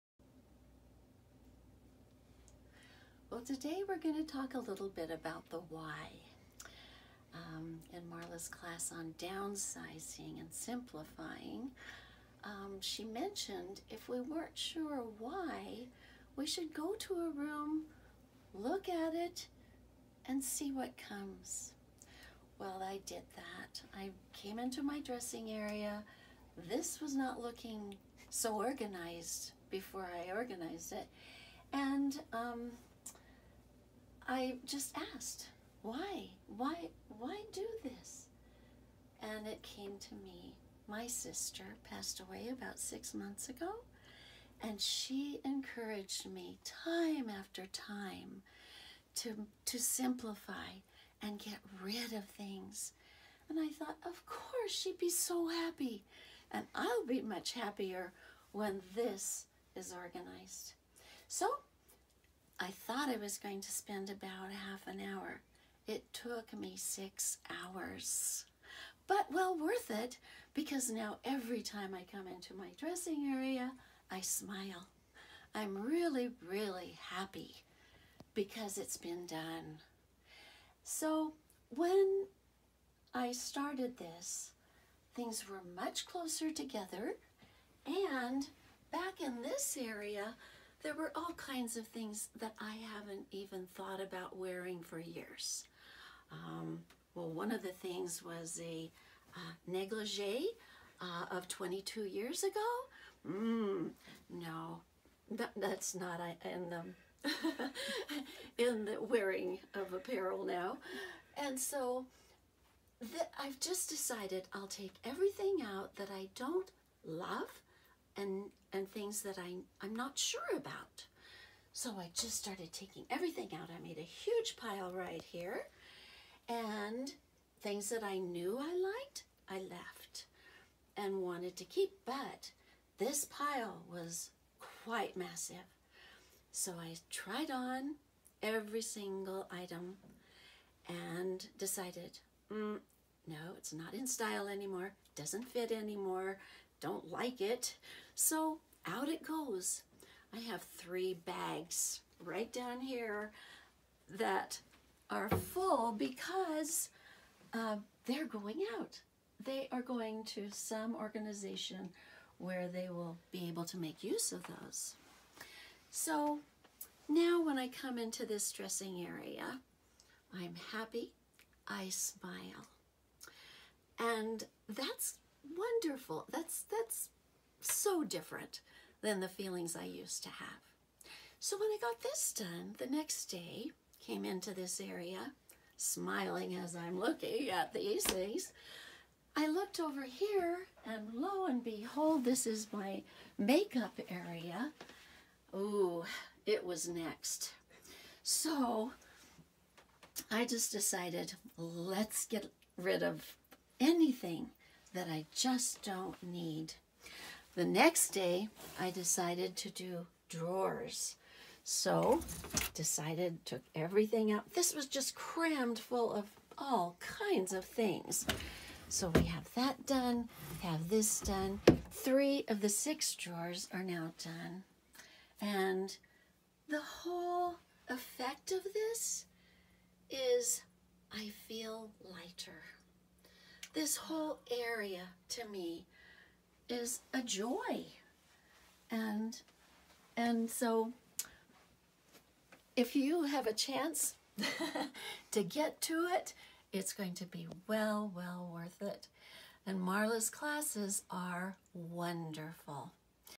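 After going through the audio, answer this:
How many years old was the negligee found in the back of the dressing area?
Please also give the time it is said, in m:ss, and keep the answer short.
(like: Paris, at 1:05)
22, at 1:41.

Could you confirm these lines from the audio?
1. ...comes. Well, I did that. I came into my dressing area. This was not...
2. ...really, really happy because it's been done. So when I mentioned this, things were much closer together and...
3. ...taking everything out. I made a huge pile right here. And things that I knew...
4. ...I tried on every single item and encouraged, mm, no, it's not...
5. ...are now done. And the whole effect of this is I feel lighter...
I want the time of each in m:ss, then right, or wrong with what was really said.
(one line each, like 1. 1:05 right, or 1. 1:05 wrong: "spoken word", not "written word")
1. 0:21 right
2. 1:15 wrong: "started", not "mentioned"
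3. 2:02 right
4. 2:16 wrong: "decided", not "encouraged"
5. 3:43 right.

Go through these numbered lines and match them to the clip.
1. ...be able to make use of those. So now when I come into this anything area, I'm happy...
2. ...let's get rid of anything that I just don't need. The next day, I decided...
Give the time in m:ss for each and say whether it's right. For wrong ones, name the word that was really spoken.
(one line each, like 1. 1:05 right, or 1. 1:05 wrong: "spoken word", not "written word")
1. 2:43 wrong: "dressing", not "anything"
2. 3:21 right.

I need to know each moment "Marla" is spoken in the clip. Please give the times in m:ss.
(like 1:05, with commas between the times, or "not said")
0:08, 4:09.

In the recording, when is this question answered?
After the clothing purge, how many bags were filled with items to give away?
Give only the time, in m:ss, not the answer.
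2:30.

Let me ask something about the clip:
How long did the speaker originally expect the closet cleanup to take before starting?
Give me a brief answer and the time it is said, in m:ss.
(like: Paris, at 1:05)
half an hour, at 1:04.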